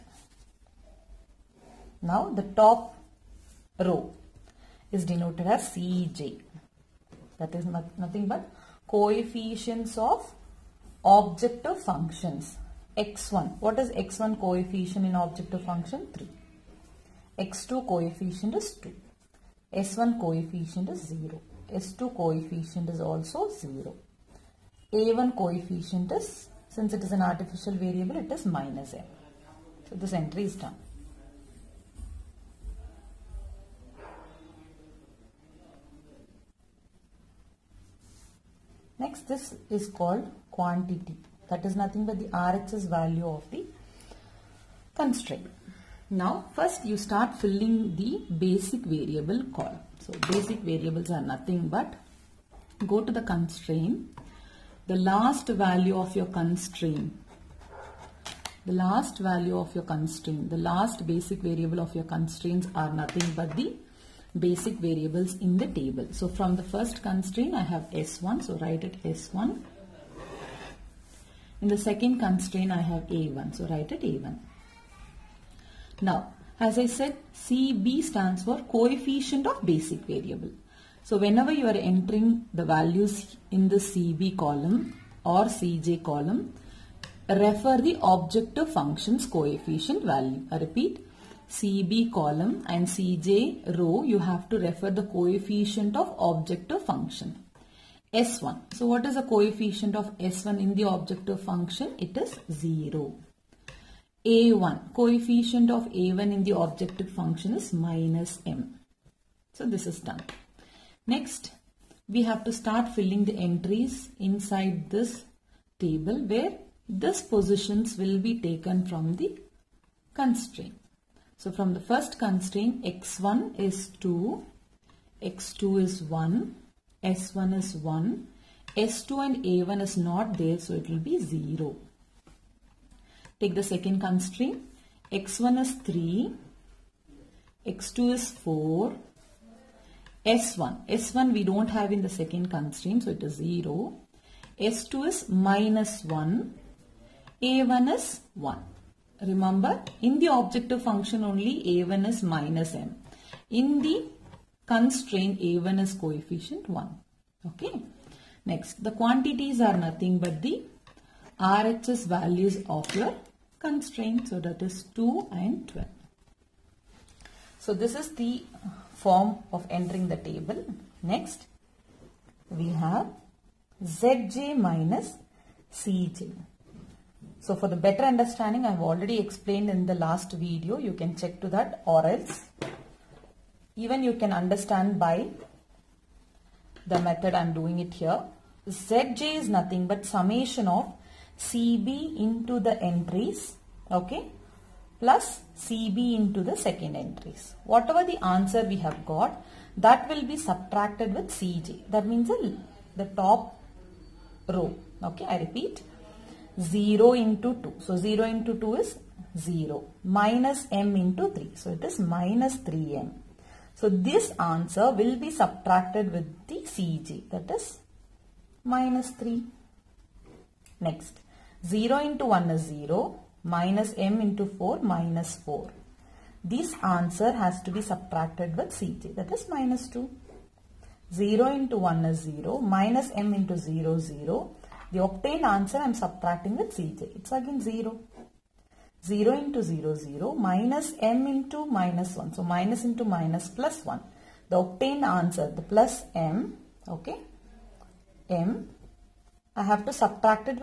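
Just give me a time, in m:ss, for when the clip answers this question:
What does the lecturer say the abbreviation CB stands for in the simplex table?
1:18.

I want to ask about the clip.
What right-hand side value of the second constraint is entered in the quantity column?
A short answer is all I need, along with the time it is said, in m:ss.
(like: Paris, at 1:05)
12, at 2:45.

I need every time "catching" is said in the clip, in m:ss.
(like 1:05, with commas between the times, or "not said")
not said.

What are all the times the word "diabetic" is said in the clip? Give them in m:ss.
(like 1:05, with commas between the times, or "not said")
not said.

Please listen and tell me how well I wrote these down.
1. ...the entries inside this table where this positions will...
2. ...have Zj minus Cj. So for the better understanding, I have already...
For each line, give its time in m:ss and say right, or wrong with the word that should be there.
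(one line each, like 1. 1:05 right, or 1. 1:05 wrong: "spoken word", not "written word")
1. 1:53 right
2. 2:52 right.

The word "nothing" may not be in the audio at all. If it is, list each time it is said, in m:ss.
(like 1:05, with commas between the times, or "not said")
0:07, 0:41, 0:51, 1:02, 2:39, 3:09.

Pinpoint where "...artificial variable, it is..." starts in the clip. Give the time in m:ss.
0:27.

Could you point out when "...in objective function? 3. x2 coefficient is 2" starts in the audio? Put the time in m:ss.
0:15.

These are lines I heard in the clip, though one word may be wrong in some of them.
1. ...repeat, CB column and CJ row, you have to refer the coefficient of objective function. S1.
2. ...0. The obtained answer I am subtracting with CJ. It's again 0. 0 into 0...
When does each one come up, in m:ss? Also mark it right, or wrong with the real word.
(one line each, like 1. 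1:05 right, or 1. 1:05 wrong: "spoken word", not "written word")
1. 1:30 right
2. 3:53 right.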